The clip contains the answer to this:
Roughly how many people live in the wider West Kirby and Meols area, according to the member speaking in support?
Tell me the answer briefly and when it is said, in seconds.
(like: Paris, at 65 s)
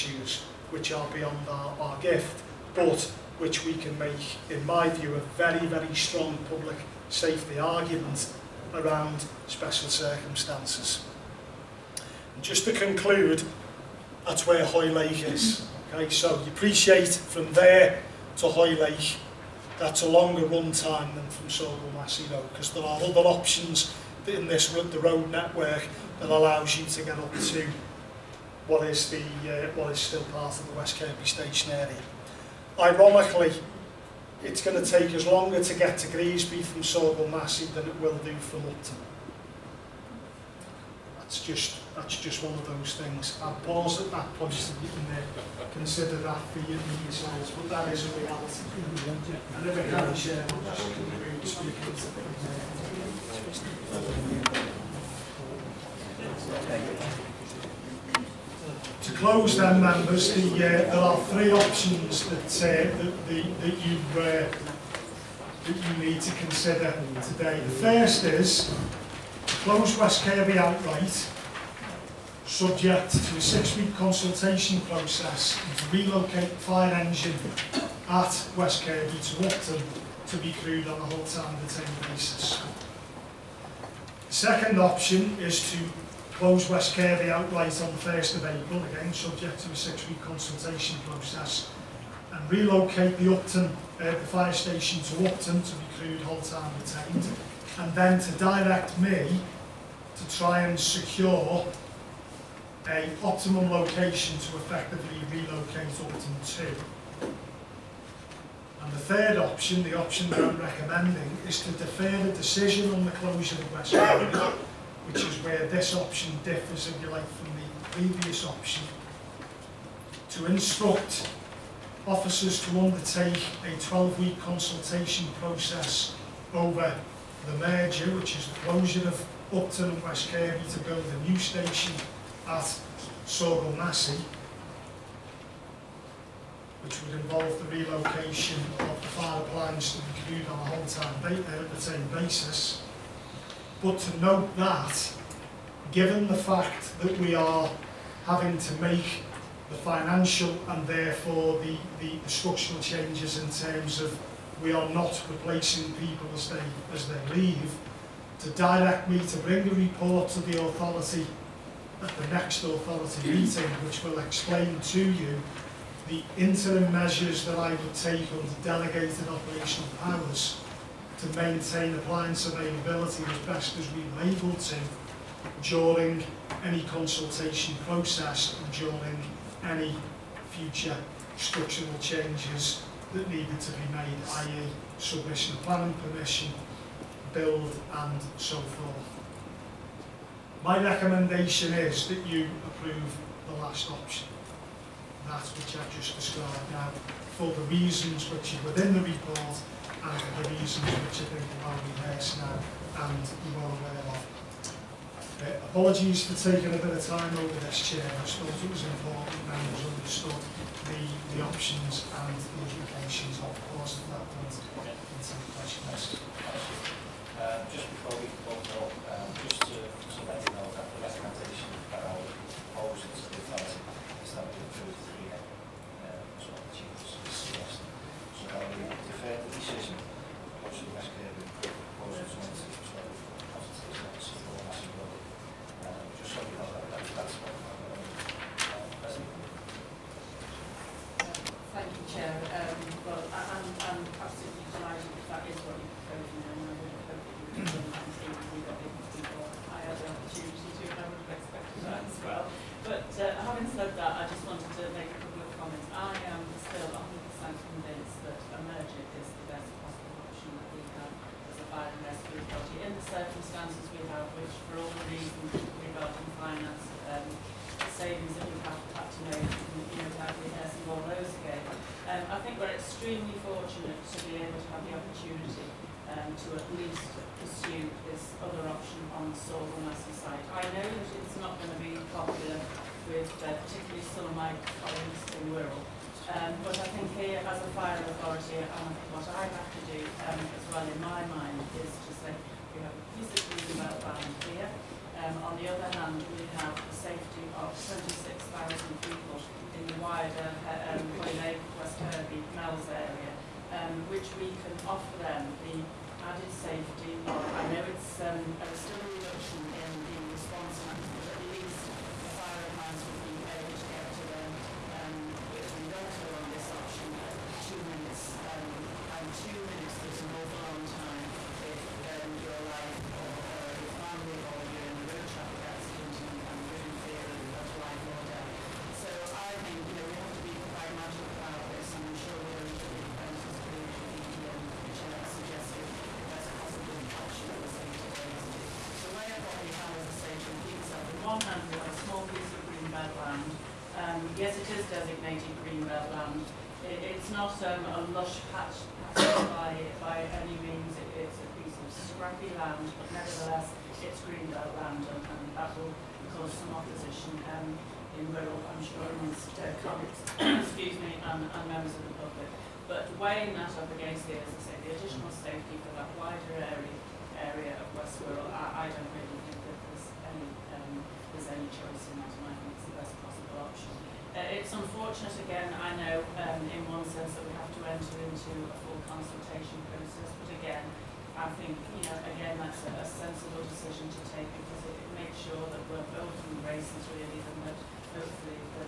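26,000, at 297 s.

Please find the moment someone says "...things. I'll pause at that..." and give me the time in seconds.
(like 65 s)
42 s.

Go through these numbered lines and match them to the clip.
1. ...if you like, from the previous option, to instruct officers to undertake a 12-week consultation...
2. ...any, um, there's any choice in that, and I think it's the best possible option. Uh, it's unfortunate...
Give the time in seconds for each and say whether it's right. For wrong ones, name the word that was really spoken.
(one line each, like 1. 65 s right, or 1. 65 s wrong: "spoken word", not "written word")
1. 116 s right
2. 370 s right.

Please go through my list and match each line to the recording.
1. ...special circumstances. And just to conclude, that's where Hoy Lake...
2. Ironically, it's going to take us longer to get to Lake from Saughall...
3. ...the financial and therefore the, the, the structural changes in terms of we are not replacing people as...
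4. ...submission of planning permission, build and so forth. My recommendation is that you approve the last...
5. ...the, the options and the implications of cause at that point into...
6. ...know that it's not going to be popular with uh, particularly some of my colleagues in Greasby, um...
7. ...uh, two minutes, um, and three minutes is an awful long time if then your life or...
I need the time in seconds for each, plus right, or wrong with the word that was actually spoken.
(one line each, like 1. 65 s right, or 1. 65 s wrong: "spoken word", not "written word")
1. 9 s right
2. 32 s wrong: "Greasby", not "Lake"
3. 149 s right
4. 184 s right
5. 210 s wrong: "course", not "cause"
6. 280 s wrong: "Wirral", not "Greasby"
7. 317 s wrong: "two", not "three".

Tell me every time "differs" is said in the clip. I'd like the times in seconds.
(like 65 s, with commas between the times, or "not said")
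116 s.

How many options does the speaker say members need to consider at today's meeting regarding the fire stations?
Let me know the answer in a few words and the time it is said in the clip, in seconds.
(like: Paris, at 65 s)
3, at 61 s.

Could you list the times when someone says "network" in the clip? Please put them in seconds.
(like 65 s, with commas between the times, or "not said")
25 s.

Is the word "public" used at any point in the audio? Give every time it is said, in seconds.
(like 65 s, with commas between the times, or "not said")
6 s, 362 s.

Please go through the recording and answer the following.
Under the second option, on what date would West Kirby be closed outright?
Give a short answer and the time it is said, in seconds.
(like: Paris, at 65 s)
1st of April, at 88 s.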